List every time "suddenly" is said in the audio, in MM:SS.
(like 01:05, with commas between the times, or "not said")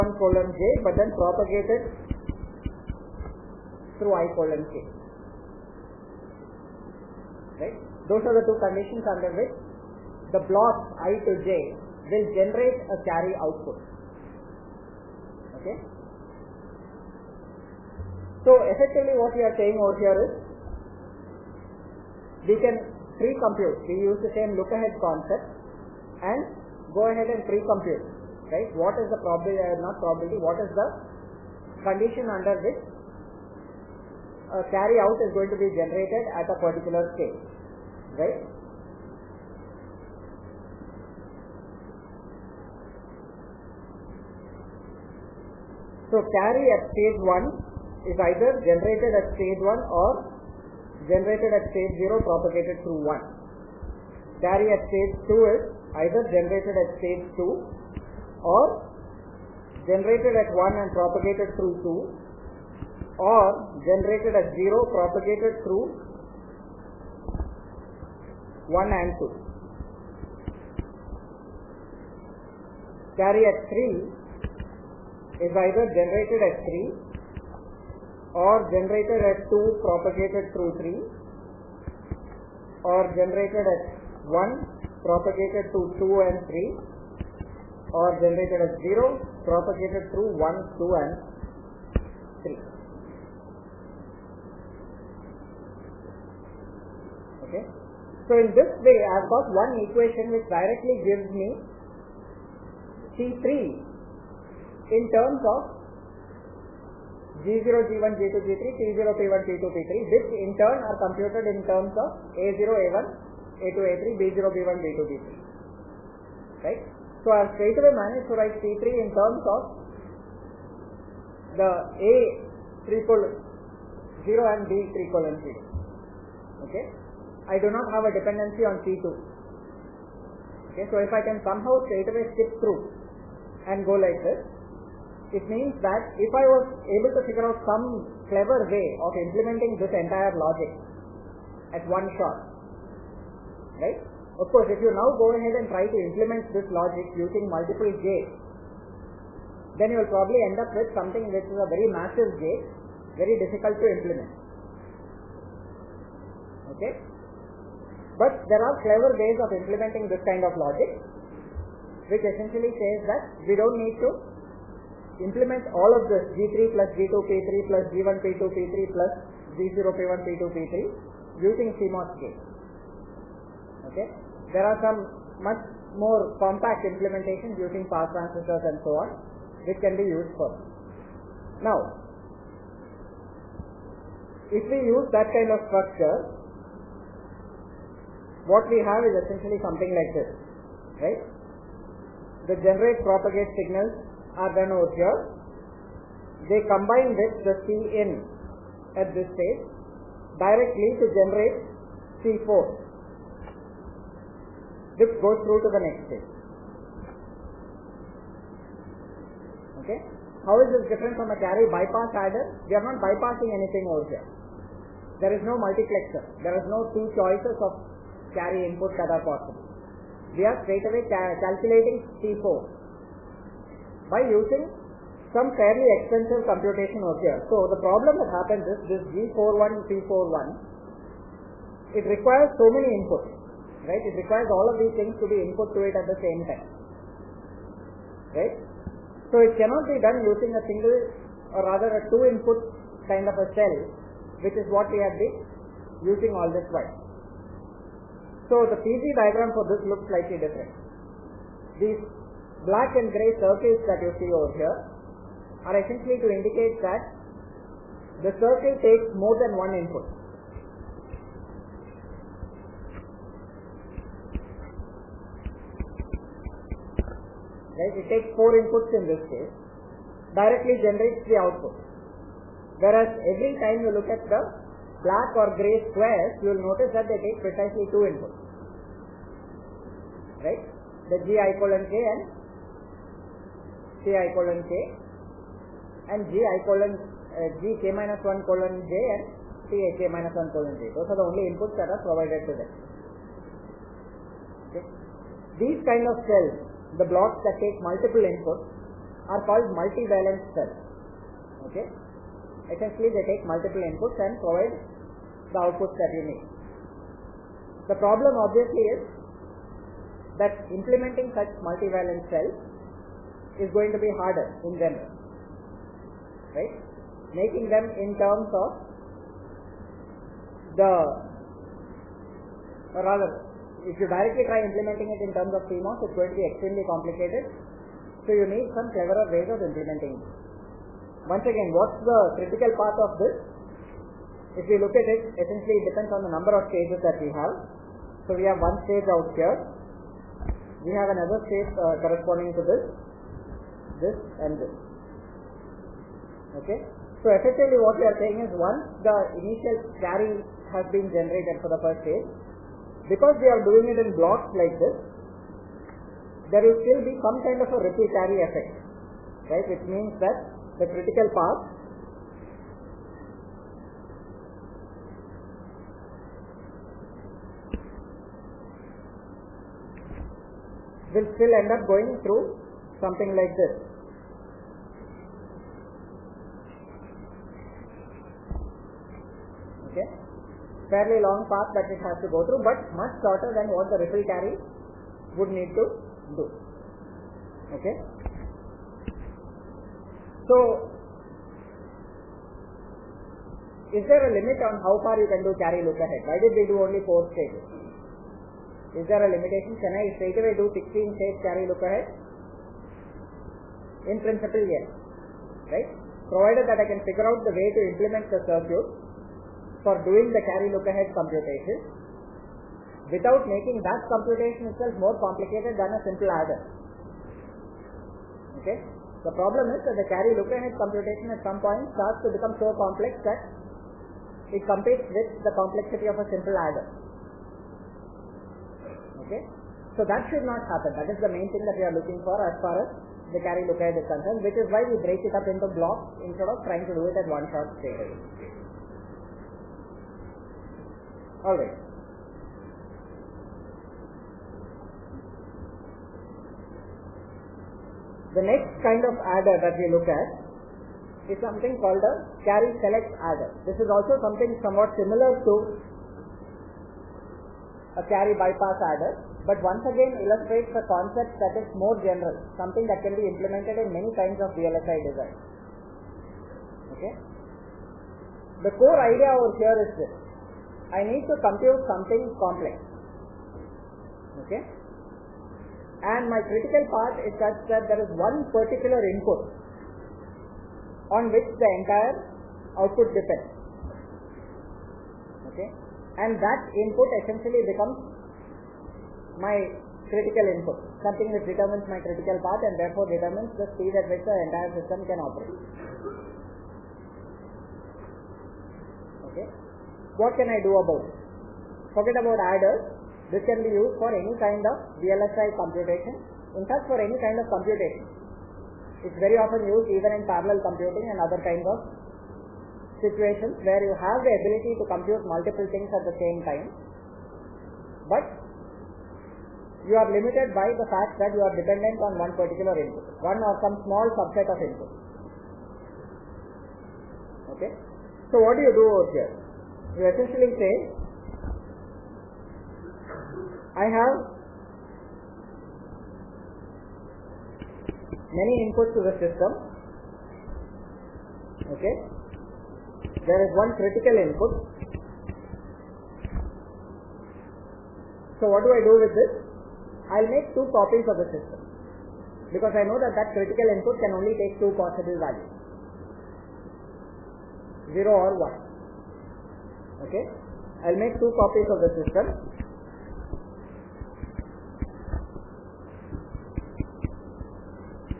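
not said.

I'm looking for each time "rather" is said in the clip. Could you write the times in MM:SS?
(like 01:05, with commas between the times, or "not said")
04:01, 05:23.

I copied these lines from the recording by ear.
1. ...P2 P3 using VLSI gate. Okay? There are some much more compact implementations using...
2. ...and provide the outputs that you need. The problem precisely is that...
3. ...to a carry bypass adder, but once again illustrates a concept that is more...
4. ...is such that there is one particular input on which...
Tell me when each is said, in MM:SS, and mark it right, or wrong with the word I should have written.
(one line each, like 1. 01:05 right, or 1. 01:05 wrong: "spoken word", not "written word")
1. 02:50 wrong: "CMOS", not "VLSI"
2. 05:04 wrong: "obviously", not "precisely"
3. 07:35 right
4. 07:57 right.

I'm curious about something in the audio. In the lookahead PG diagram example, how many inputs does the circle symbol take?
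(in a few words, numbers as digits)
4.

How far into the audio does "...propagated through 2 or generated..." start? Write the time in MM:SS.
01:00.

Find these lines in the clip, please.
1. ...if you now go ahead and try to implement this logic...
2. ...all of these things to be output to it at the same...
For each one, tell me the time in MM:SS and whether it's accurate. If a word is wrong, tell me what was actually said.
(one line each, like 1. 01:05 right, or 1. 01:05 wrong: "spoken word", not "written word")
1. 02:24 right
2. 03:54 wrong: "input", not "output".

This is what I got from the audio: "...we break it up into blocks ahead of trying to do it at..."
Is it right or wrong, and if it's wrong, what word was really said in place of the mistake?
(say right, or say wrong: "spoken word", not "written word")
wrong: "instead", not "ahead".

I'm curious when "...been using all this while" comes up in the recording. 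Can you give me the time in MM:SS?
04:05.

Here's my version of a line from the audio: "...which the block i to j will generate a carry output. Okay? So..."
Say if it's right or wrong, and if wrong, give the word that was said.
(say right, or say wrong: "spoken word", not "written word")
right.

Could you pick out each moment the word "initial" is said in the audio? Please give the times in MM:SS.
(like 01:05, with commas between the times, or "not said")
05:49.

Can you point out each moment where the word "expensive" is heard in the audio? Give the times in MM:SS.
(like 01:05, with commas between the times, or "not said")
03:46.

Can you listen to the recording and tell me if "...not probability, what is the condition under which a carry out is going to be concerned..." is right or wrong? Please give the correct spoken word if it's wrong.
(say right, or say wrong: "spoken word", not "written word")
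wrong: "generated", not "concerned".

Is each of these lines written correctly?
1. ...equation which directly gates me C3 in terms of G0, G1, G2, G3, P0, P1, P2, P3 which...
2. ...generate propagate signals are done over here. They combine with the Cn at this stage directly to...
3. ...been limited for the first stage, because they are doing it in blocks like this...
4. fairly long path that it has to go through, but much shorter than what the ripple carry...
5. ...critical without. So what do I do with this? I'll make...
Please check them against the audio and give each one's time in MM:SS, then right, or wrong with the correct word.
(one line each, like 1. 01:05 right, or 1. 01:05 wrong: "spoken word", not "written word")
1. 01:39 wrong: "gives", not "gates"
2. 03:12 right
3. 05:50 wrong: "generated", not "limited"
4. 06:20 right
5. 09:03 wrong: "input", not "without".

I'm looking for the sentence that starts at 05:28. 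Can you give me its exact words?
So you need some cleverer ways of implementing it.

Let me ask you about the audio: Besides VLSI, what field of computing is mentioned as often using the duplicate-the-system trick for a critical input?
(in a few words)
parallel computing.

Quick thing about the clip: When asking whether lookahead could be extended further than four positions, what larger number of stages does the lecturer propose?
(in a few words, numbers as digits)
16.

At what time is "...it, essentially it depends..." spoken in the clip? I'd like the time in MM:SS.
05:35.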